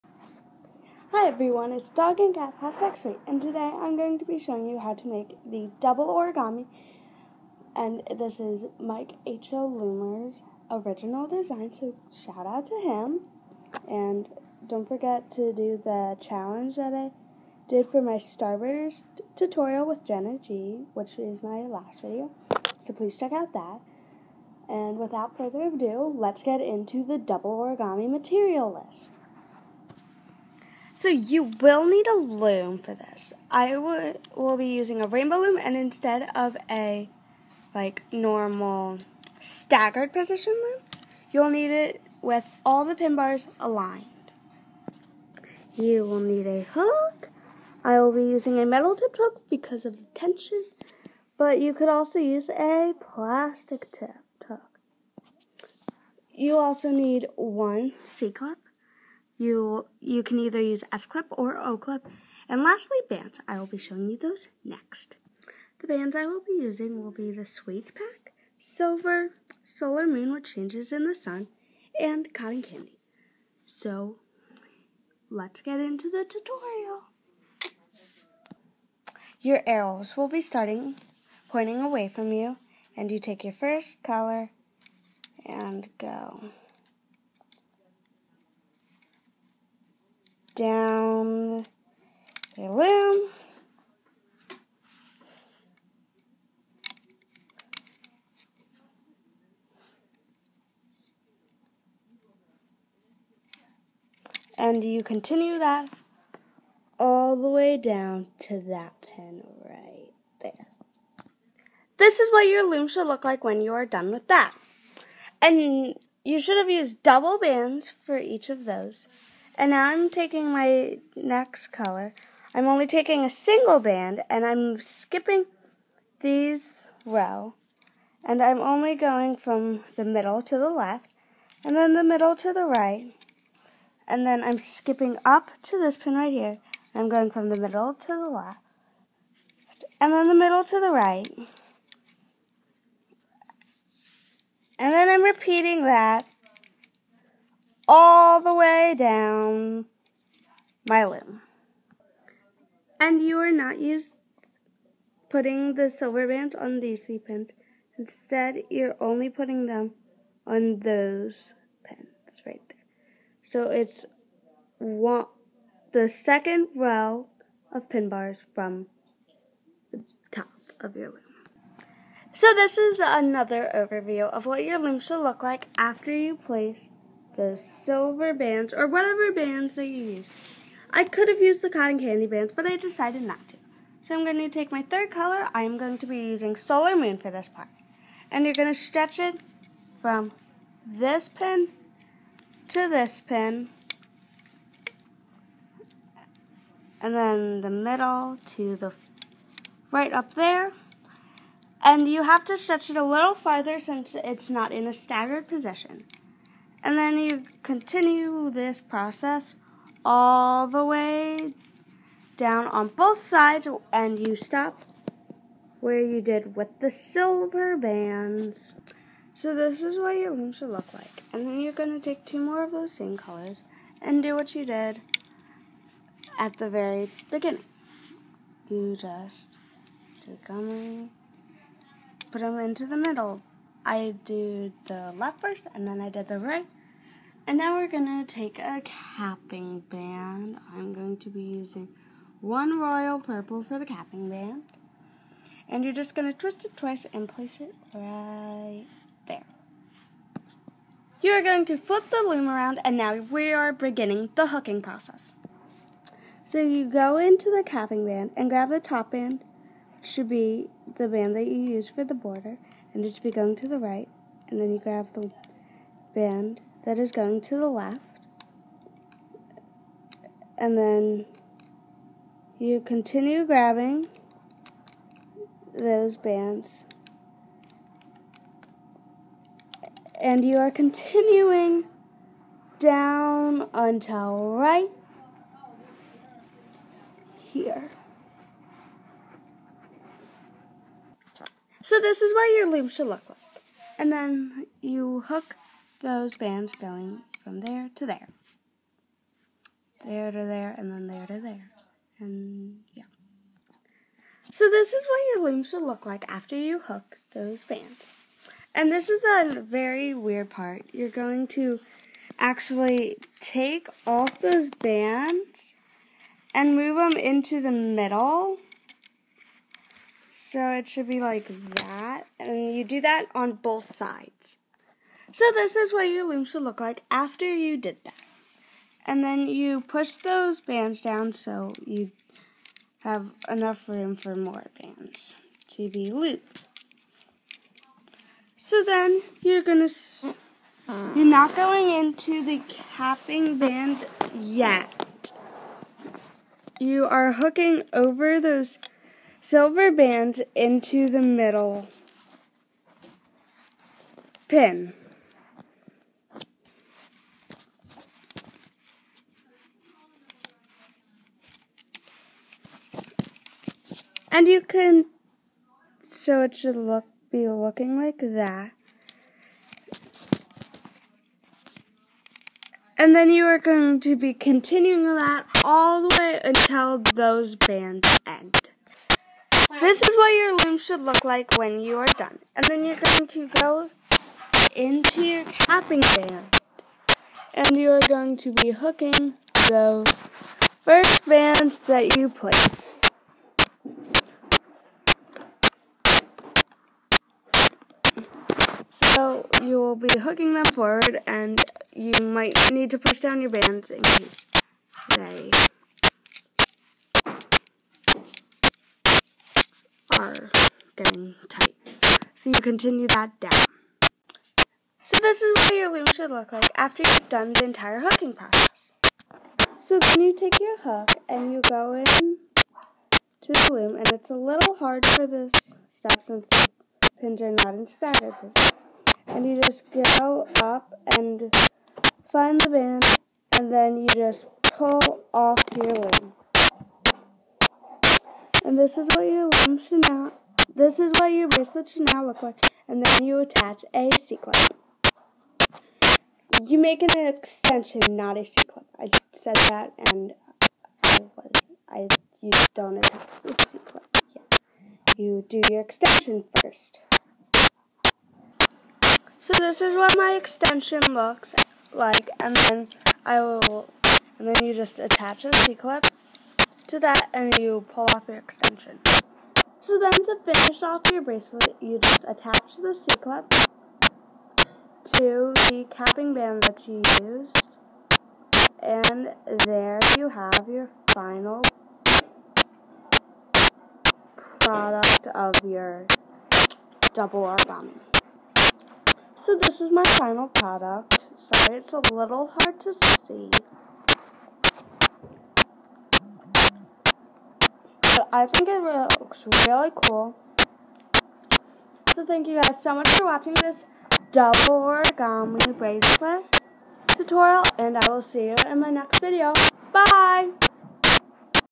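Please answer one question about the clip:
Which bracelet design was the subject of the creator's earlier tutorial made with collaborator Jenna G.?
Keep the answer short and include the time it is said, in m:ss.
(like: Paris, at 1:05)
Starburst, at 0:18.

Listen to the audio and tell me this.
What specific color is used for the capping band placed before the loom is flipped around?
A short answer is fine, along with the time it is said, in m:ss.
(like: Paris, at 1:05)
Royal purple, at 4:02.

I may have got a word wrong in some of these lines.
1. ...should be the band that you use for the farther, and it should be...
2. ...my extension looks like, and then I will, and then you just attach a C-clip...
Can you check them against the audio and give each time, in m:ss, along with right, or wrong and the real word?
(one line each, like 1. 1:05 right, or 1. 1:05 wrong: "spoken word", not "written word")
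1. 4:20 wrong: "border", not "farther"
2. 7:40 right.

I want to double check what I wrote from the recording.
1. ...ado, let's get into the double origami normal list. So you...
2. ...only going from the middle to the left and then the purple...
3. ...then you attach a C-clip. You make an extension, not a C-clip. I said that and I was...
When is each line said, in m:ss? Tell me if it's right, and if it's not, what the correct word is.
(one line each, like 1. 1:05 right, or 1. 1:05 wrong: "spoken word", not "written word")
1. 0:25 wrong: "material", not "normal"
2. 2:08 wrong: "middle", not "purple"
3. 7:23 right.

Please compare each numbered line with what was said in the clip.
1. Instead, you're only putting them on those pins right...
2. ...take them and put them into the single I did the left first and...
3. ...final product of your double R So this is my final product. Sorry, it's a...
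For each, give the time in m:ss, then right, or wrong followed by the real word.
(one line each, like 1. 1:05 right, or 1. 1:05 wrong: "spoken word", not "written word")
1. 2:37 right
2. 3:50 wrong: "middle", not "single"
3. 8:01 right.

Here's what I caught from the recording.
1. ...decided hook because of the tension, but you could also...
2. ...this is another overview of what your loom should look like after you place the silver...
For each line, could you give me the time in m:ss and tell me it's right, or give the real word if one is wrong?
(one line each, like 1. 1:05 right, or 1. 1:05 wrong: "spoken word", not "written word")
1. 0:48 wrong: "tipped", not "decided"
2. 2:52 right.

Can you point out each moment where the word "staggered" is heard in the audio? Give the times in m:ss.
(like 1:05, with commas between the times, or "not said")
0:39, 3:24.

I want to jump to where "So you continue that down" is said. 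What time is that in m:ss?
6:52.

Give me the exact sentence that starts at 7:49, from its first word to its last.
So then to finish off your bracelet, you just attach the C-clip to the capping band that you used.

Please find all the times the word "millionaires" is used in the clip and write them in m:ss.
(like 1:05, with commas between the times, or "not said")
not said.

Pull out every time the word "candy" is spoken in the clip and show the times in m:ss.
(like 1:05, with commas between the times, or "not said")
1:12, 3:01.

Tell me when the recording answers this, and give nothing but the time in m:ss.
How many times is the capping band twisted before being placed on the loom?
4:06.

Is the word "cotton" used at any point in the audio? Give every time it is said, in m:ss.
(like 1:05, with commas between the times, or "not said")
1:12, 3:01.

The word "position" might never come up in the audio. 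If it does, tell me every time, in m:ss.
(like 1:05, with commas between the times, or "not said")
0:40, 3:25.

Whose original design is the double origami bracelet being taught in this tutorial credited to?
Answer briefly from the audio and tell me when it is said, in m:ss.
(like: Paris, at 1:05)
Mike H.O. Loomer, at 0:08.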